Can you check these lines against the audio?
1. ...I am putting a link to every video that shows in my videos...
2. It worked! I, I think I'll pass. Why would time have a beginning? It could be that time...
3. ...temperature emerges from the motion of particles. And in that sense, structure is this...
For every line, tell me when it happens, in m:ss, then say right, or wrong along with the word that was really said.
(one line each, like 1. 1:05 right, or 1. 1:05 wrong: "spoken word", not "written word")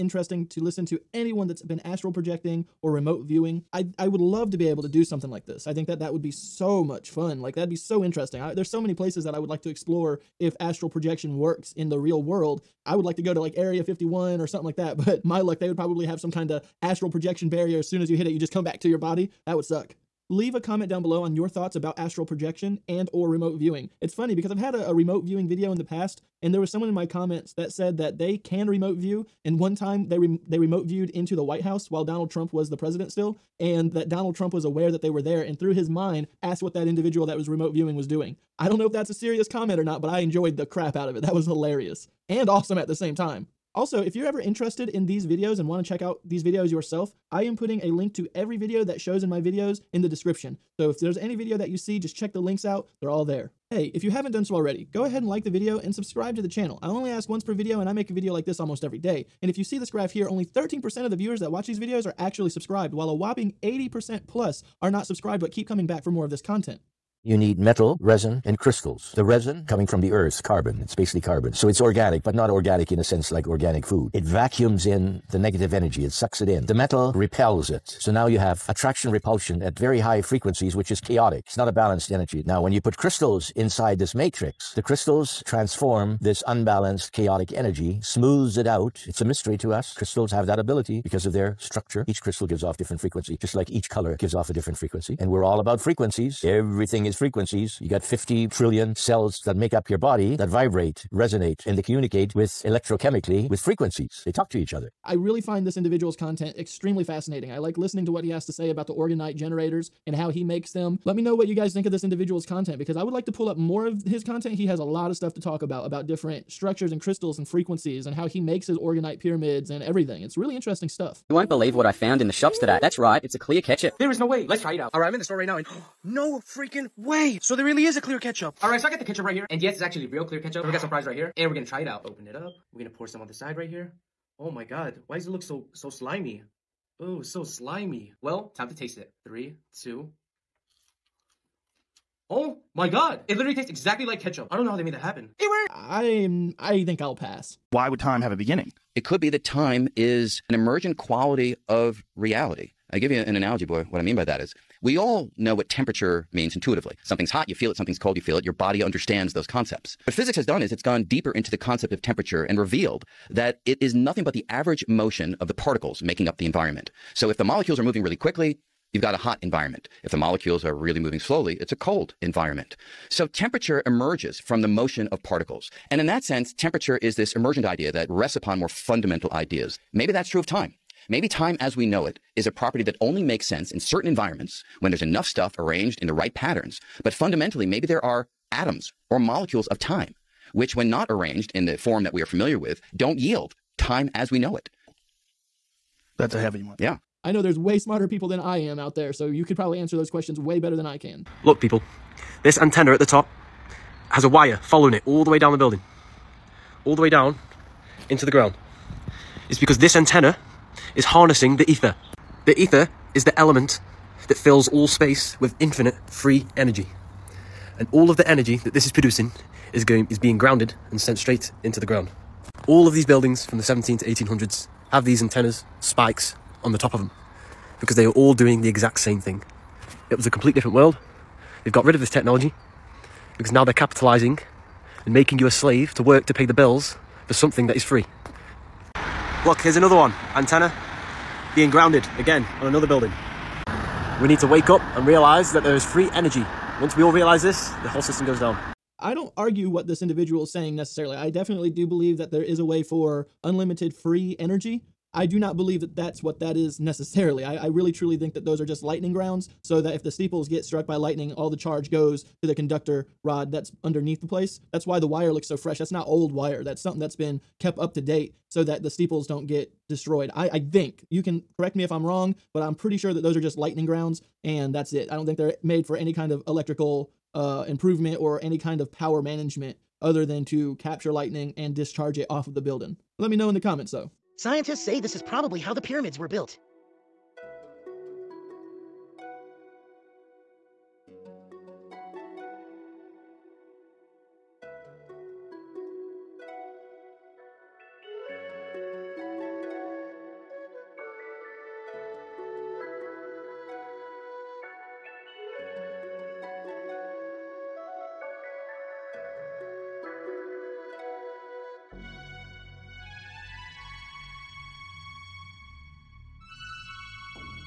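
1. 0:47 right
2. 2:25 right
3. 2:53 wrong: "temperature", not "structure".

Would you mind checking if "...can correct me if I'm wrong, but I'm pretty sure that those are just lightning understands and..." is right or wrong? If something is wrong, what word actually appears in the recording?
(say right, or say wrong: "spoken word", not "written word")
wrong: "grounds", not "understands".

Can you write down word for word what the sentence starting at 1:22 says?
Now, when you put crystals inside this matrix, the crystals transform this unbalanced chaotic energy smooths it out.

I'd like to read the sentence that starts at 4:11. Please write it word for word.
I definitely do believe that there is a way for unlimited free energy.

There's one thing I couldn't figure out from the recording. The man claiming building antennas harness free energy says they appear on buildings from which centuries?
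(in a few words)
1700s to 1800s.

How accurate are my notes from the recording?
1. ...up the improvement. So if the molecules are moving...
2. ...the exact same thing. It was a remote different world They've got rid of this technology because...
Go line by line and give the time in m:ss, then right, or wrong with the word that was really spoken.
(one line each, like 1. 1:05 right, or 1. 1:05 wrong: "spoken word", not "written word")
1. 2:46 wrong: "environment", not "improvement"
2. 3:48 wrong: "complete", not "remote".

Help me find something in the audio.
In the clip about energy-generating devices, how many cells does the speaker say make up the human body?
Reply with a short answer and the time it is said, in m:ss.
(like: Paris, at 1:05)
50 trillion, at 1:38.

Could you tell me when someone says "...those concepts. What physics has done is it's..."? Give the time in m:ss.
2:39.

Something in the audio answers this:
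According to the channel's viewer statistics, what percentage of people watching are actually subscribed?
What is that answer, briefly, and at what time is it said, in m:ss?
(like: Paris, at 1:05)
13%, at 1:00.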